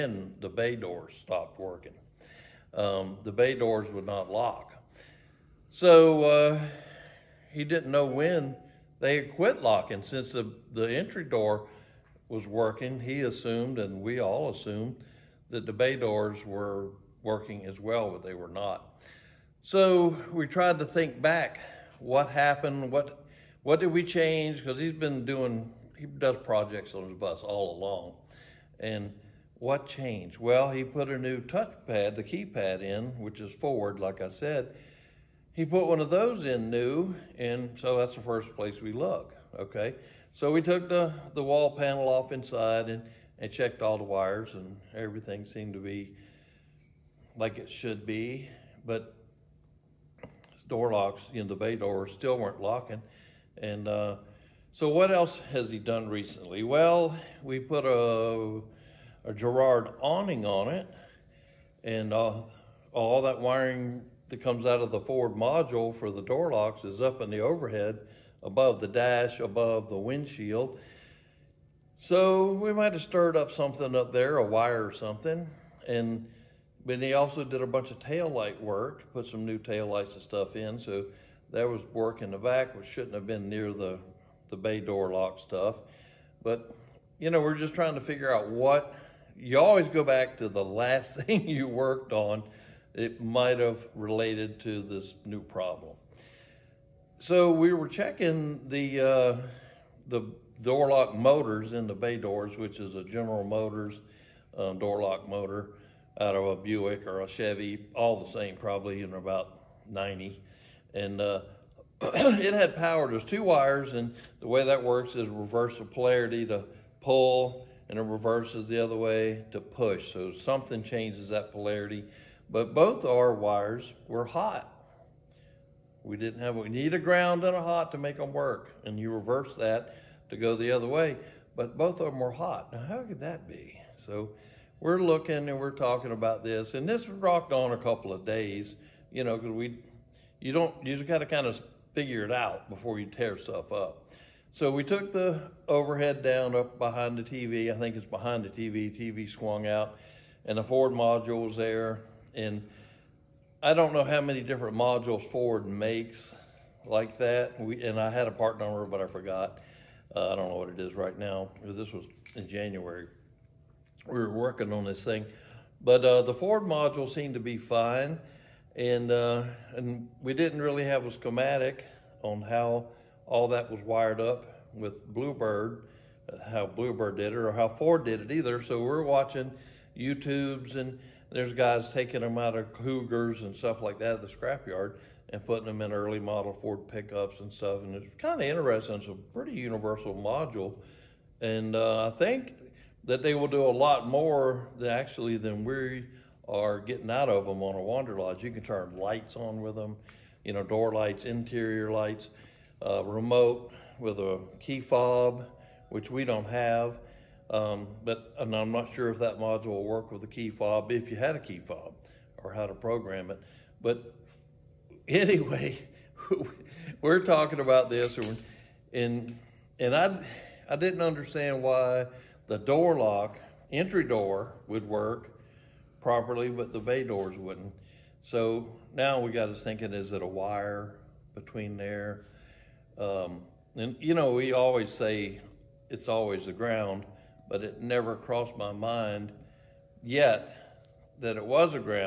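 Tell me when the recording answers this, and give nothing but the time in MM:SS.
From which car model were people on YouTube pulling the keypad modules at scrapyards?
03:02.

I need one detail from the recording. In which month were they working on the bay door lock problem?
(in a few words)
January.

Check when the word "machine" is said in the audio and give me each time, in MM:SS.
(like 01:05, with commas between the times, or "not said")
not said.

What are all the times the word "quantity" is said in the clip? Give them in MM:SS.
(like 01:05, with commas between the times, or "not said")
not said.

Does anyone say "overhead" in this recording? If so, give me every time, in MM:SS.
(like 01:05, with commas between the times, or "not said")
01:07, 02:25.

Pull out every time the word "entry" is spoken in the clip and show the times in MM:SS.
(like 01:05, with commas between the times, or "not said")
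00:10, 03:43.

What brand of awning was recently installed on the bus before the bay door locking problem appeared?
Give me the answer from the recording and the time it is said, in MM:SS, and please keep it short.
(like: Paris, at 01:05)
Girard, at 00:59.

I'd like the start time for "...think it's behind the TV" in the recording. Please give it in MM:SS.
02:27.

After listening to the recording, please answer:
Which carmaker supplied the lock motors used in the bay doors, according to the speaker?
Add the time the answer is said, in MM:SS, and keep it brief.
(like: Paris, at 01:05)
General Motors, at 01:43.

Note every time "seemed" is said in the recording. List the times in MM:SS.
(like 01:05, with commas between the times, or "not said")
00:45, 02:47.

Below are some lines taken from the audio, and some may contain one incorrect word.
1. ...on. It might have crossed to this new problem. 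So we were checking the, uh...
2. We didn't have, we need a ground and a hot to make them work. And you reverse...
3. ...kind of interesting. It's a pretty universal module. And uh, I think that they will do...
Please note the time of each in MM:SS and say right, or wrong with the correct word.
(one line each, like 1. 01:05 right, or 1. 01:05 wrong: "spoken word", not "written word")
1. 01:32 wrong: "related", not "crossed"
2. 02:06 right
3. 03:08 right.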